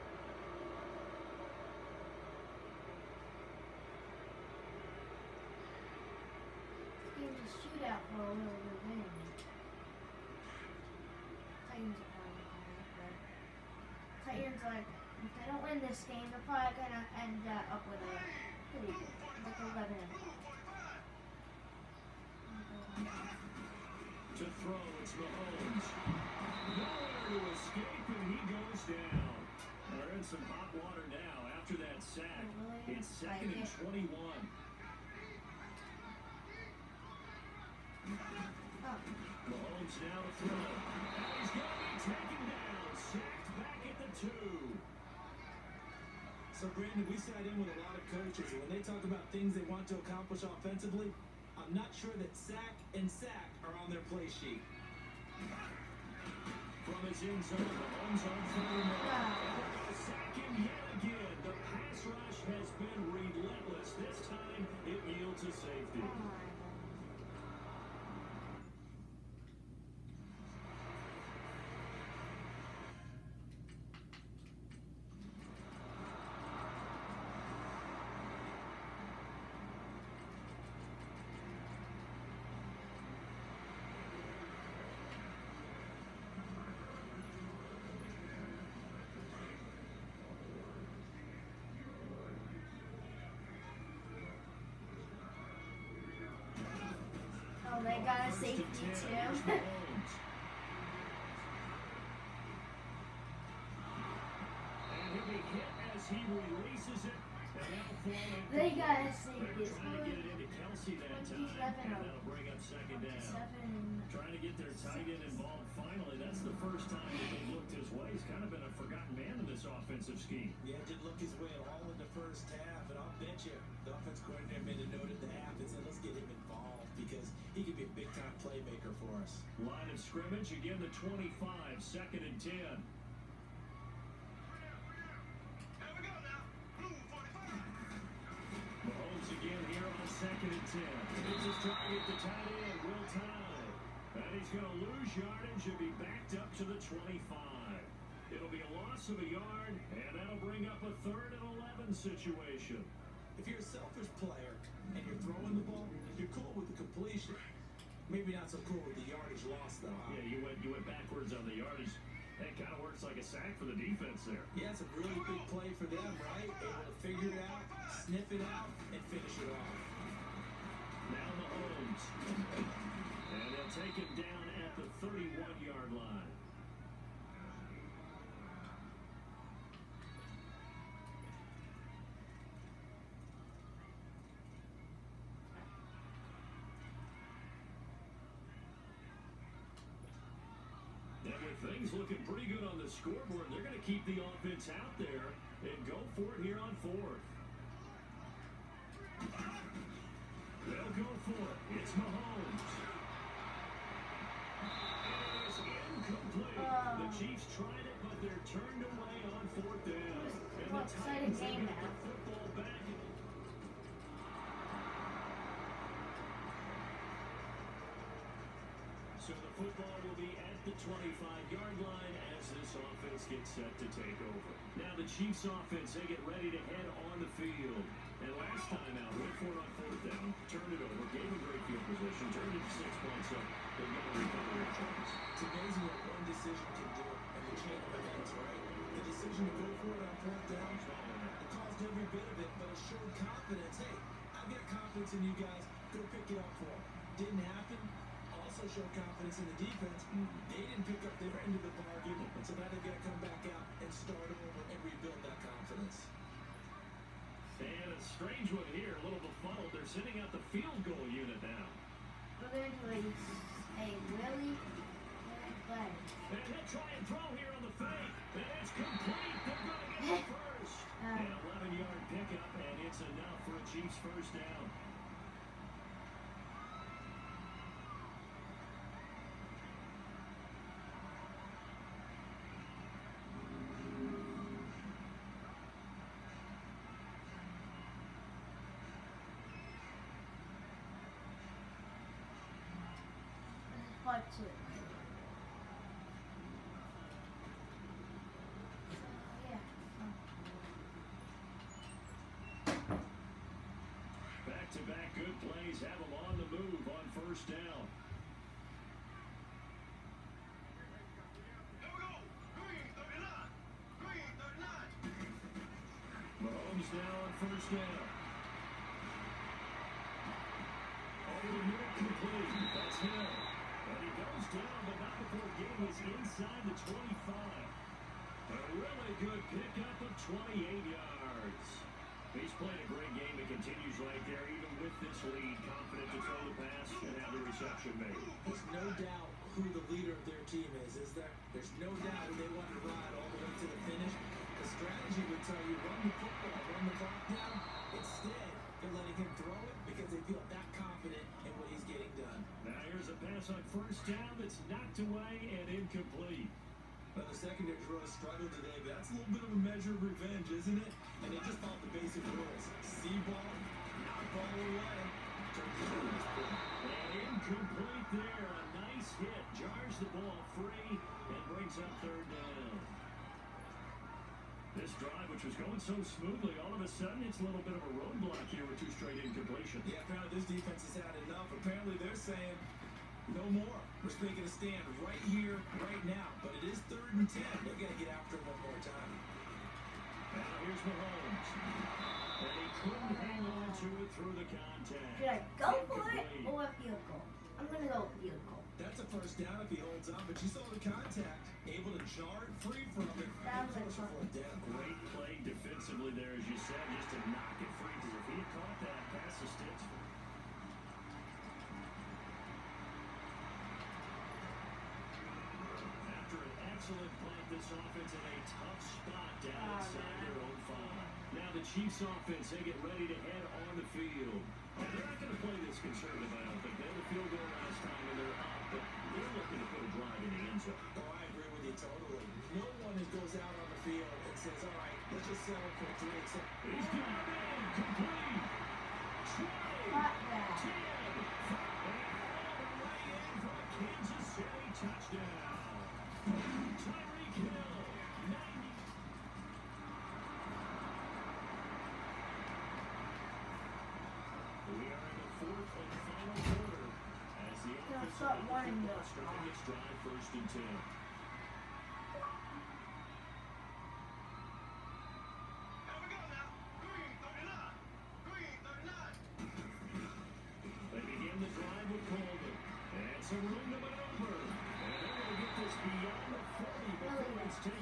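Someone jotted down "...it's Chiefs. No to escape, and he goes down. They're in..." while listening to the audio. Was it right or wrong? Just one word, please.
wrong.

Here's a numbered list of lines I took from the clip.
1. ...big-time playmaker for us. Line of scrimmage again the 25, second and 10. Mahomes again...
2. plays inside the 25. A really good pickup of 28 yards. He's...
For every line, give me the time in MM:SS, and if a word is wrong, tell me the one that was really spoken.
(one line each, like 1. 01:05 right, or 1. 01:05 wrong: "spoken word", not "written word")
1. 02:07 right
2. 05:25 right.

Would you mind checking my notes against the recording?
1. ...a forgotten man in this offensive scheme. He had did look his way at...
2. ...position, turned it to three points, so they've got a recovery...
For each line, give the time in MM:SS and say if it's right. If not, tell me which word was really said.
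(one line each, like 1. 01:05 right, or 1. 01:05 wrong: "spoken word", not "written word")
1. 01:58 right
2. 03:51 wrong: "six", not "three".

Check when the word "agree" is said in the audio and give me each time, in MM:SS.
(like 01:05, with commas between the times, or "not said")
07:11.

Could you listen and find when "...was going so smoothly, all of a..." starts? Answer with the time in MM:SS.
06:15.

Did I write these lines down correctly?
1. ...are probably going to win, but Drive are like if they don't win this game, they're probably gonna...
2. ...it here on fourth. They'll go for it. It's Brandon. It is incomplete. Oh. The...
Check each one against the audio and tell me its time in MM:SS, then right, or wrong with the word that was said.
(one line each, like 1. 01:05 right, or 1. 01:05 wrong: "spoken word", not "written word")
1. 00:12 wrong: "Titans", not "Drive"
2. 03:16 wrong: "Mahomes", not "Brandon".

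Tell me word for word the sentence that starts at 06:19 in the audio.
Yeah, apparently this defense has had enough.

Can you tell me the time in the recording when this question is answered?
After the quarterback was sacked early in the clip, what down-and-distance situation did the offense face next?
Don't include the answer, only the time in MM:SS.
00:33.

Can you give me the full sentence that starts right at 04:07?
Didn't happen also showed confidence in the defense.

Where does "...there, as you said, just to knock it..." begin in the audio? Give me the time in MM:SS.
06:46.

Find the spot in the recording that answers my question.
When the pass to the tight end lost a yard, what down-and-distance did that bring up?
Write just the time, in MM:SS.
02:31.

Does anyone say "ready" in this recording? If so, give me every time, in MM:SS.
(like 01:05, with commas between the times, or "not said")
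03:46, 07:02.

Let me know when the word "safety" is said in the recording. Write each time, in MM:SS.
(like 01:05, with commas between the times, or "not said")
01:38, 01:49.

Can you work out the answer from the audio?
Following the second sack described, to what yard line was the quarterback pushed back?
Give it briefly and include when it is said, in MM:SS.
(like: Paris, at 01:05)
the 2, at 00:43.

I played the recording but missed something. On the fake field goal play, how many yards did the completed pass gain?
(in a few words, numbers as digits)
11 yards.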